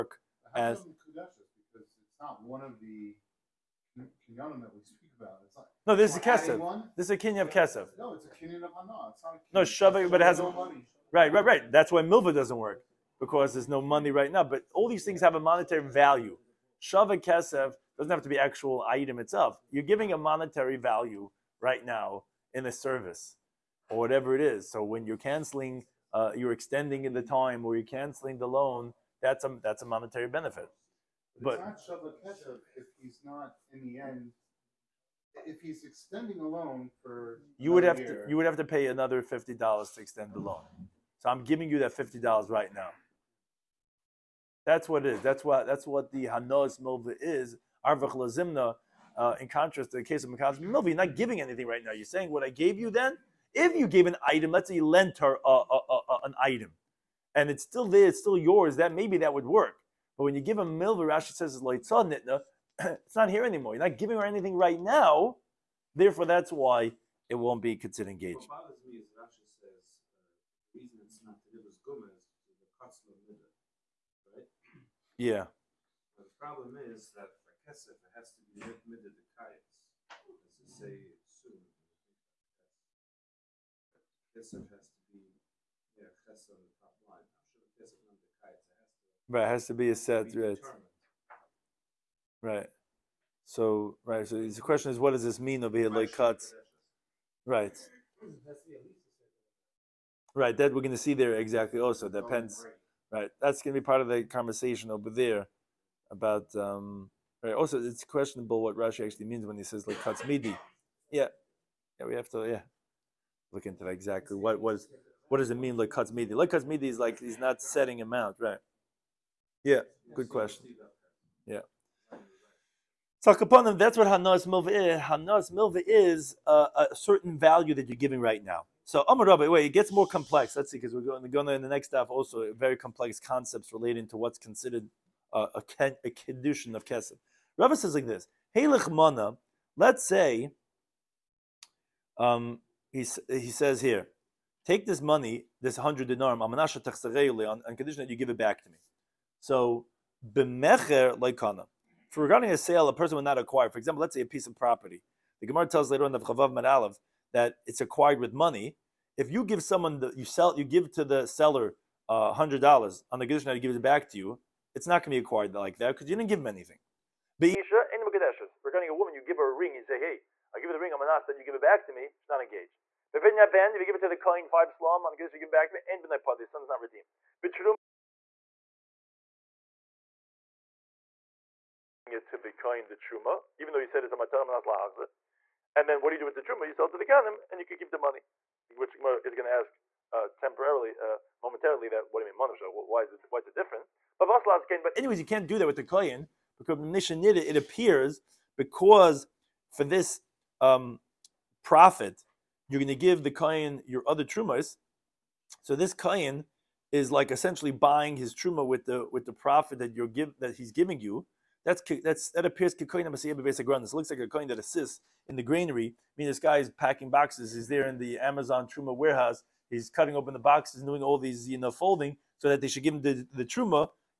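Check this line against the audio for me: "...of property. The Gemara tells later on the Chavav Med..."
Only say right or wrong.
right.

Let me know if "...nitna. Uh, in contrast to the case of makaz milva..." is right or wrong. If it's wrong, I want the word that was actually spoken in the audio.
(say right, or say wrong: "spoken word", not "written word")
wrong: "lazimna", not "nitna".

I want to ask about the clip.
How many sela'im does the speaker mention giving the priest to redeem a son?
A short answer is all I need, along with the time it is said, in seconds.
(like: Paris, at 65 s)
5, at 174 s.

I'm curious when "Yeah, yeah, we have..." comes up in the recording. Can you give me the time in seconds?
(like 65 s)
111 s.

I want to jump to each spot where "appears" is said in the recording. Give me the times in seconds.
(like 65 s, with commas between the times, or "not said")
197 s, 212 s.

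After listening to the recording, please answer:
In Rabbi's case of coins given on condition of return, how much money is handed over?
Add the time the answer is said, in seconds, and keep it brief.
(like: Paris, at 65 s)
100 dinarim, at 145 s.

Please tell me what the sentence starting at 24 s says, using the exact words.
So when you're canceling, uh, you're extending in the time or you're canceling the loan, that's a, that's a monetary benefit.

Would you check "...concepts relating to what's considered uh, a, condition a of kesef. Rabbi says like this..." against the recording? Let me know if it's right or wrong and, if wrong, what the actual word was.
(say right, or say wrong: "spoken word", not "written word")
right.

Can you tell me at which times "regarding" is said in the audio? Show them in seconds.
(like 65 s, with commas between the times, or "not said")
152 s, 168 s.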